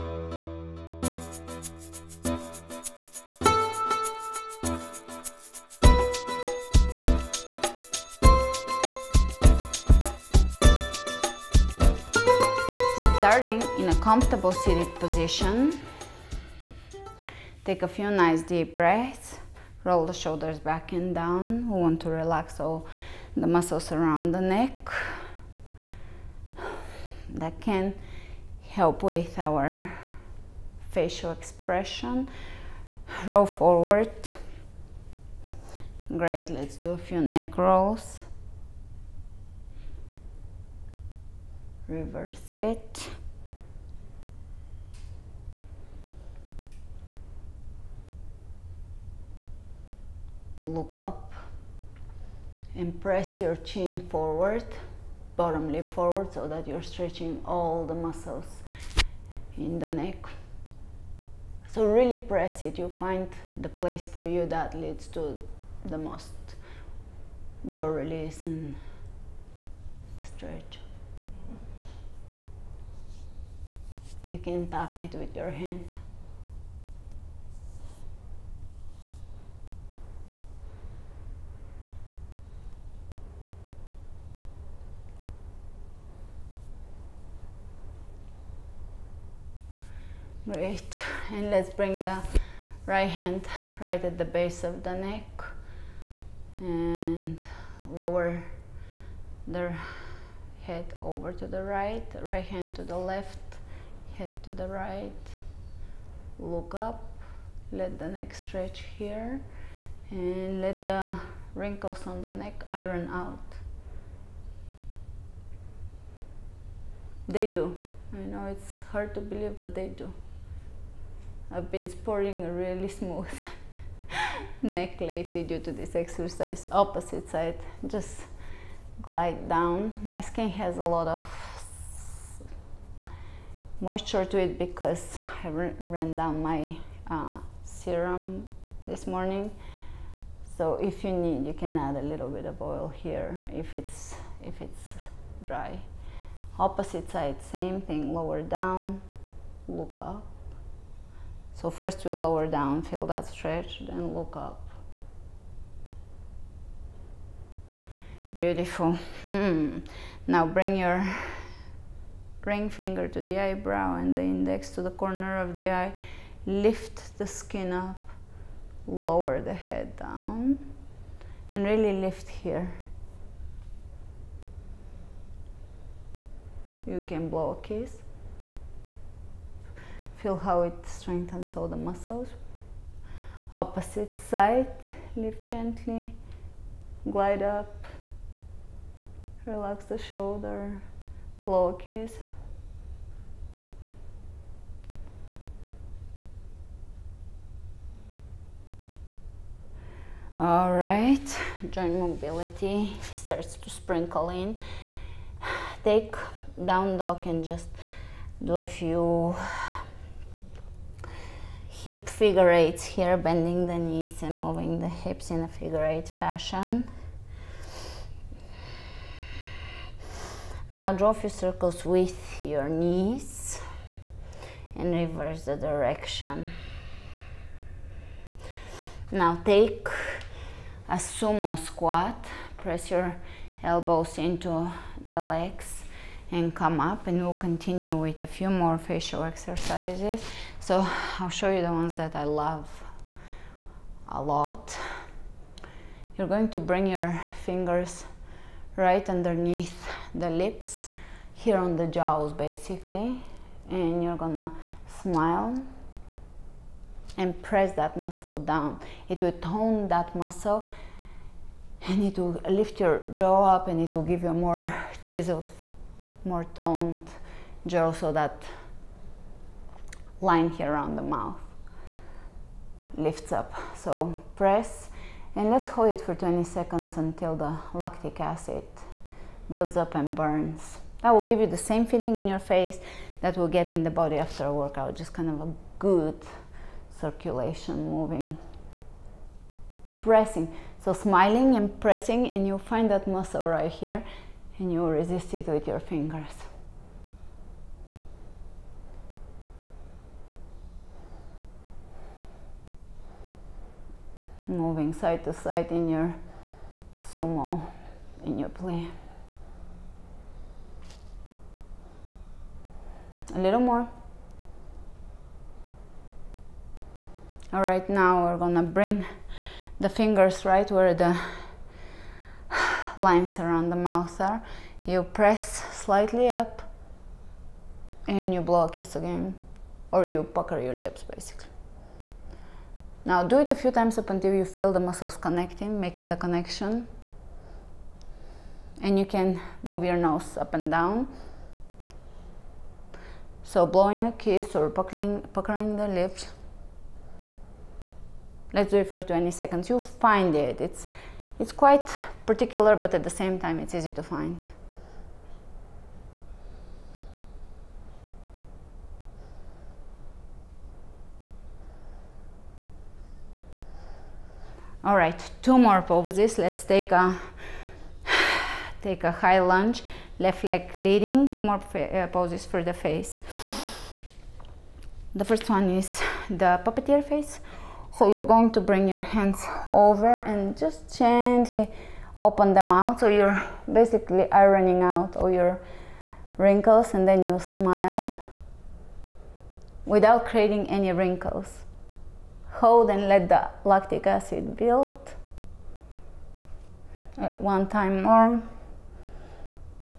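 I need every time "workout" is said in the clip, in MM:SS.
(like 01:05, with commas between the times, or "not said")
04:44.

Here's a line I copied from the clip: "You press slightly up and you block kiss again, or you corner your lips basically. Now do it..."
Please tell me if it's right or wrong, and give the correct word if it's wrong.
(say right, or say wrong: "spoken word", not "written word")
wrong: "pucker", not "corner".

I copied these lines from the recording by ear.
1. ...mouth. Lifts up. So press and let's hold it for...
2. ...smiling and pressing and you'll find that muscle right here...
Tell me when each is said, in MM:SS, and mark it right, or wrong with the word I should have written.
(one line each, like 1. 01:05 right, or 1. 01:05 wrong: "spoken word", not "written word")
1. 04:31 right
2. 04:50 right.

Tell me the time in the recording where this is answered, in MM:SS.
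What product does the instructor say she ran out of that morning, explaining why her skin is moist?
02:17.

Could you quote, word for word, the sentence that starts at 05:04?
moving side to side in your sumo, in your play.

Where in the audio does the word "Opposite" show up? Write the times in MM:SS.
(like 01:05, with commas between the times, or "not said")
02:06, 02:26, 03:03.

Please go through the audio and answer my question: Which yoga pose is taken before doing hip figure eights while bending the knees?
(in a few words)
down dog.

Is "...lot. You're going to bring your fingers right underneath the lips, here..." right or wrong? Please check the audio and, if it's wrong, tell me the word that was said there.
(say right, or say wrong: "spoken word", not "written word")
right.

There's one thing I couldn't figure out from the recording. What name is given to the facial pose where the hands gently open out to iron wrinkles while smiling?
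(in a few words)
puppeteer face.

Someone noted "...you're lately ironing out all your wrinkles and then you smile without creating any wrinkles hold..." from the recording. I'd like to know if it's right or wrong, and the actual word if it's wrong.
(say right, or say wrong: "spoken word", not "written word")
wrong: "basically", not "lately".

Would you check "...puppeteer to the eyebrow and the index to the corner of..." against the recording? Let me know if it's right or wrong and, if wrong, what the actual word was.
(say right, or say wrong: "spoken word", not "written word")
wrong: "finger", not "puppeteer".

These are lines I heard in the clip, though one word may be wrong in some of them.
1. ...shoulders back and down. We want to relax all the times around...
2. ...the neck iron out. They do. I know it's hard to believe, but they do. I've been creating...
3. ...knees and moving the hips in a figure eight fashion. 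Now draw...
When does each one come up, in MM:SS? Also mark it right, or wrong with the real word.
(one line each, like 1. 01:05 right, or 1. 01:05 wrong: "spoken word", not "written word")
1. 00:20 wrong: "muscles", not "times"
2. 01:52 wrong: "sporting", not "creating"
3. 03:33 right.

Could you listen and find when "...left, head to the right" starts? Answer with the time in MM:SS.
01:42.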